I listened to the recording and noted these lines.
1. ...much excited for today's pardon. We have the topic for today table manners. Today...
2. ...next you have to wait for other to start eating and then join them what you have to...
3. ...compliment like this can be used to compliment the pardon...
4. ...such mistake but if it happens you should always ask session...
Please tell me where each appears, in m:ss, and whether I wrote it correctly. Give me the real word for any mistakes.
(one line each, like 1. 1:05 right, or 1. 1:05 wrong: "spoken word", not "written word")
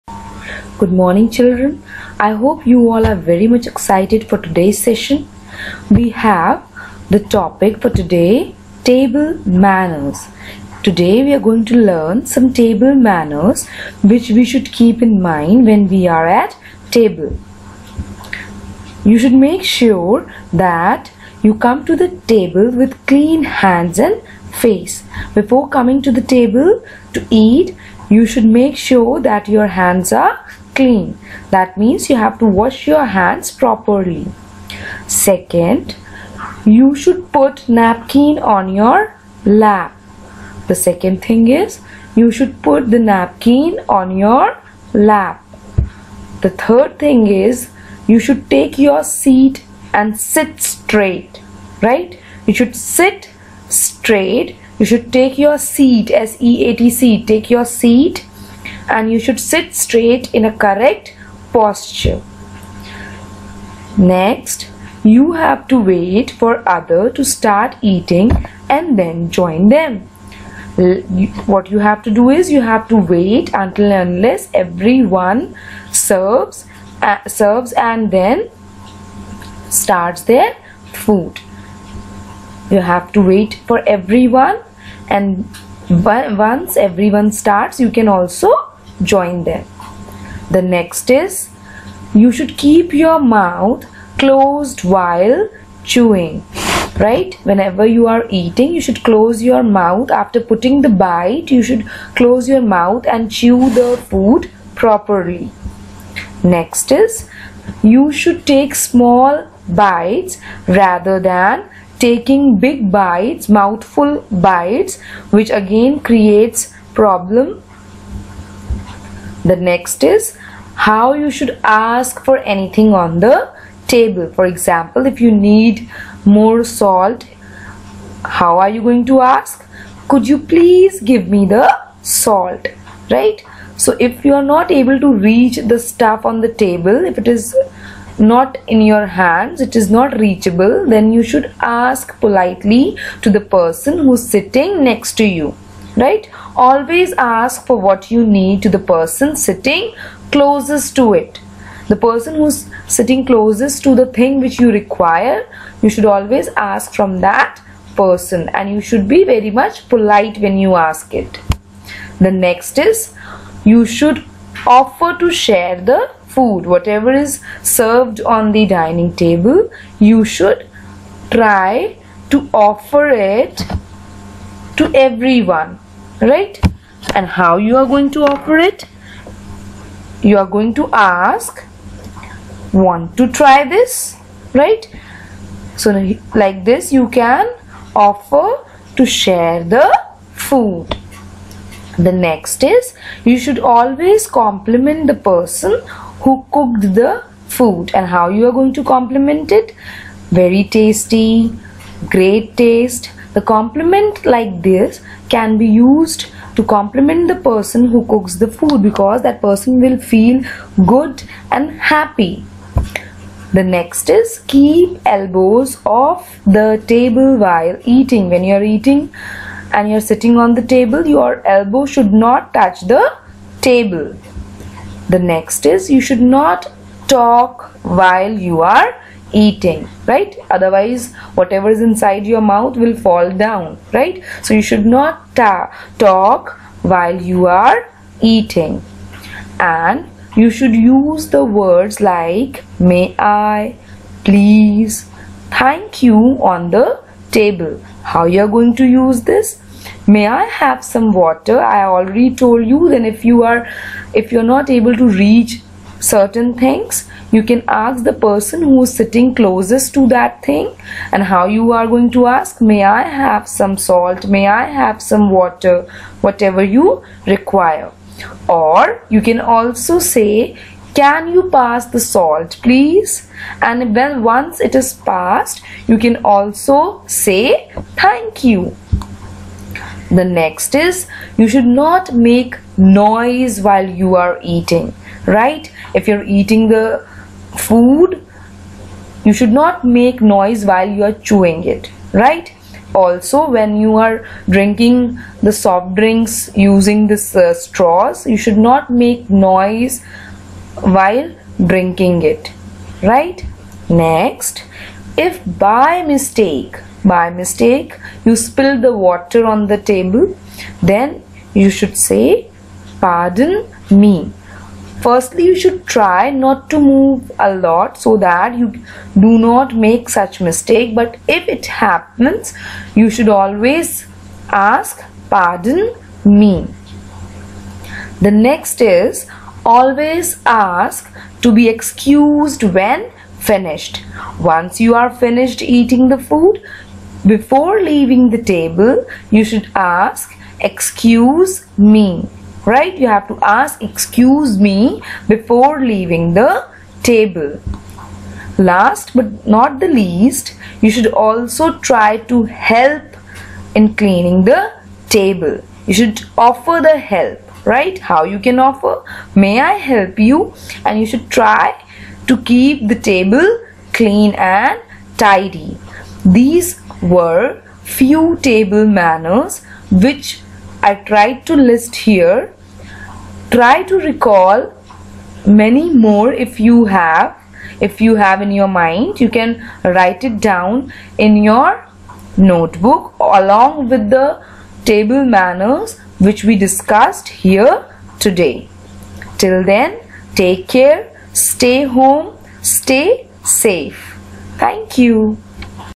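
1. 0:03 wrong: "session", not "pardon"
2. 1:04 right
3. 3:23 wrong: "person", not "pardon"
4. 5:20 wrong: "pardon", not "session".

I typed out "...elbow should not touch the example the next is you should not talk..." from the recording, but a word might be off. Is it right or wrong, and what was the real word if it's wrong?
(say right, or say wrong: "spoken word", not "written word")
wrong: "table", not "example".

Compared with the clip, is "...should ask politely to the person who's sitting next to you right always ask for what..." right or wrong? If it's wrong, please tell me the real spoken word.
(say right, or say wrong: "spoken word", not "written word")
right.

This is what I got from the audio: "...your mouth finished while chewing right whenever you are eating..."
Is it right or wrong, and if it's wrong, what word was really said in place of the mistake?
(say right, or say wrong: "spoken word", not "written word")
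wrong: "closed", not "finished".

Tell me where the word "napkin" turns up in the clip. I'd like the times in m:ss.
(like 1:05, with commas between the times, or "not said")
0:37, 0:43.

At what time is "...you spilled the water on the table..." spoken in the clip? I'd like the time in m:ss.
5:08.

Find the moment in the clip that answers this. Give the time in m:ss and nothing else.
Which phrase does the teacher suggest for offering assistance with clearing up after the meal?
5:59.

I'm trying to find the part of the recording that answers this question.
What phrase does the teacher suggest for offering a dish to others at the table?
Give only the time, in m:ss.
3:02.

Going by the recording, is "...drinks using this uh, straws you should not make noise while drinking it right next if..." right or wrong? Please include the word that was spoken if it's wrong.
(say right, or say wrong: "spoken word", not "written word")
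right.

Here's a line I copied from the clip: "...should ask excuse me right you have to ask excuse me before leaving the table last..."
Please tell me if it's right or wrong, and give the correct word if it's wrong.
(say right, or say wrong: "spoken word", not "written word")
right.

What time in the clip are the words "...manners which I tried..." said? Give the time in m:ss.
6:08.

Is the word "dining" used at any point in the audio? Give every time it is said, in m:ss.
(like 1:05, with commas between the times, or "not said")
2:48.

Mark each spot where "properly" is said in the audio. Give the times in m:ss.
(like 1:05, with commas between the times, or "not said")
0:33, 1:44.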